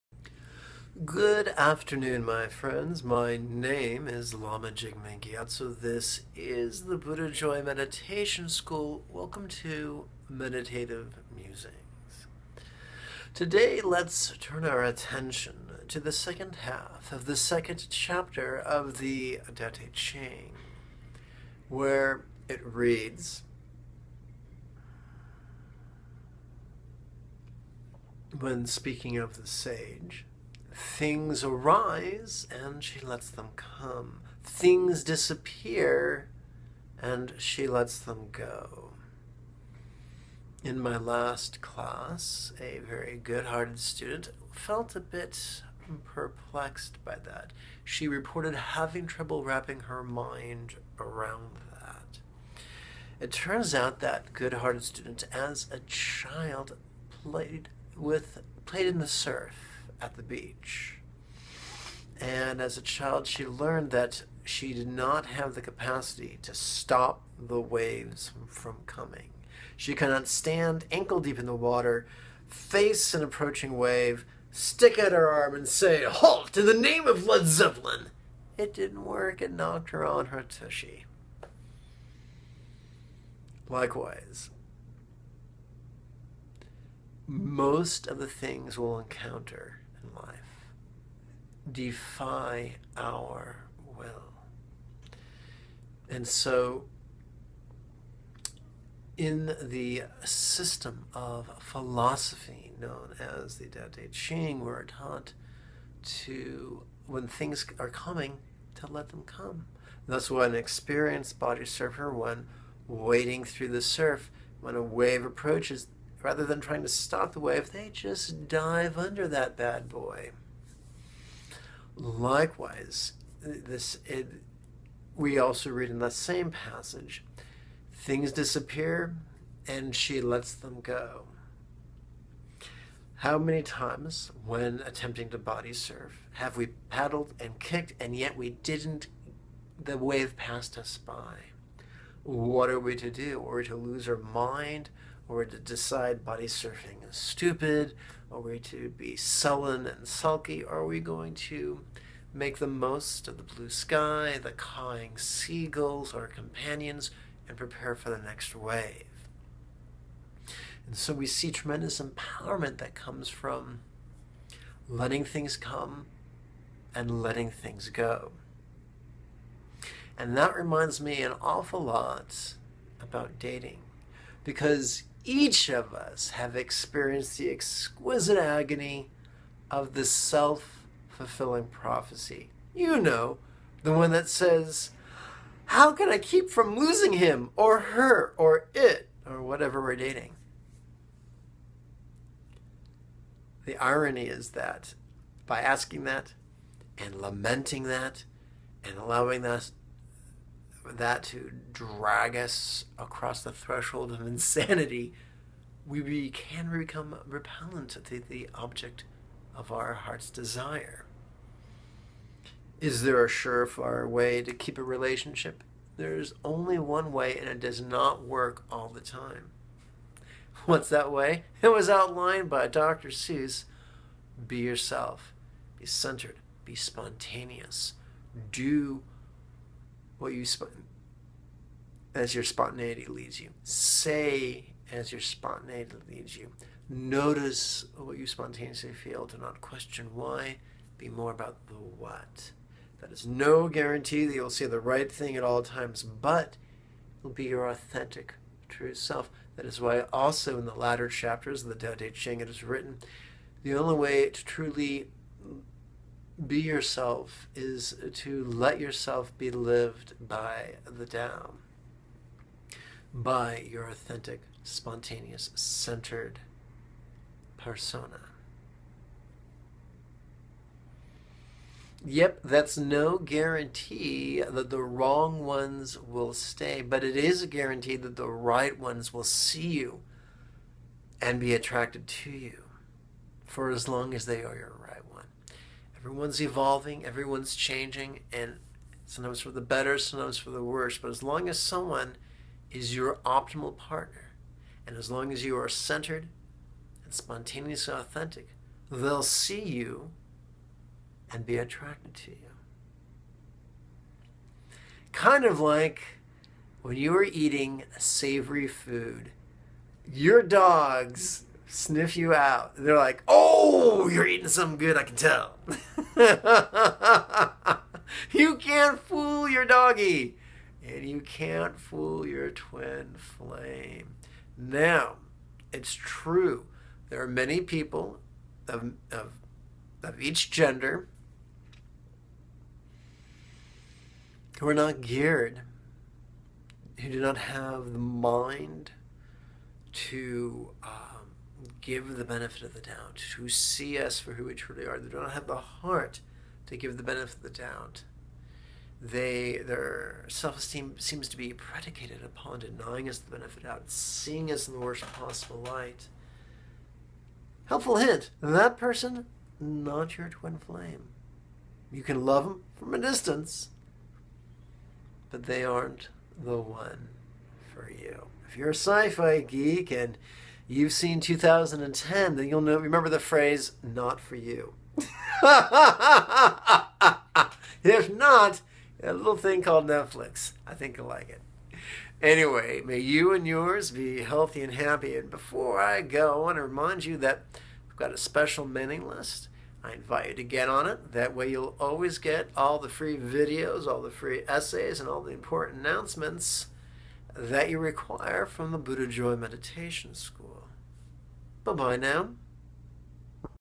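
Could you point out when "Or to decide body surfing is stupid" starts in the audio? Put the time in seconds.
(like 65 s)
145 s.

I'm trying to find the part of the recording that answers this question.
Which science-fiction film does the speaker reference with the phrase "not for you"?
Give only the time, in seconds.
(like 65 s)
371 s.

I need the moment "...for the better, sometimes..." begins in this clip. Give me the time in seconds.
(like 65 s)
289 s.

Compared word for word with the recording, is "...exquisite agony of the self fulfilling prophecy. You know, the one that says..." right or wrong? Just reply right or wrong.
right.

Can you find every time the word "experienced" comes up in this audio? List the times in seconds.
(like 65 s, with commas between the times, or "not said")
110 s, 176 s.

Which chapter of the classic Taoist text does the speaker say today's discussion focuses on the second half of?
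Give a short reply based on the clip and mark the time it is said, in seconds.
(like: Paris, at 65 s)
Second chapter, at 17 s.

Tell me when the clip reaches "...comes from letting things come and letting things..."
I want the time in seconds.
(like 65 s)
162 s.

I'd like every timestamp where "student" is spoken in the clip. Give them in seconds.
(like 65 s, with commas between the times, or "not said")
43 s, 54 s.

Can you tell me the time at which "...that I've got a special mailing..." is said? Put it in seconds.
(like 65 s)
387 s.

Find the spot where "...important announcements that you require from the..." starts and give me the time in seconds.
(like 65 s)
395 s.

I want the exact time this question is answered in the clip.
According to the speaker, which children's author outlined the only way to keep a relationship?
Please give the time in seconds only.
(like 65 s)
222 s.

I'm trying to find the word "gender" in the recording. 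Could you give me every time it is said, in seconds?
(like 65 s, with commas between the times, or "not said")
330 s.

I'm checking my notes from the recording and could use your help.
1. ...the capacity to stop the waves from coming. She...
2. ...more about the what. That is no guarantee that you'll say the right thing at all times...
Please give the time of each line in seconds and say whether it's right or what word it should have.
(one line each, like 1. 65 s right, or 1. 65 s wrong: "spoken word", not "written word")
1. 65 s right
2. 241 s right.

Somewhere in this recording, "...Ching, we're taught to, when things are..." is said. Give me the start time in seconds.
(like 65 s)
104 s.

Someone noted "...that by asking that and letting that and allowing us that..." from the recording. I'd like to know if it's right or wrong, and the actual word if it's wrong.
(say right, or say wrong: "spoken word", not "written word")
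wrong: "lamenting", not "letting".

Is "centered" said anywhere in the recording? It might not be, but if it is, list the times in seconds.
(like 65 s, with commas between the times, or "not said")
225 s, 265 s, 295 s.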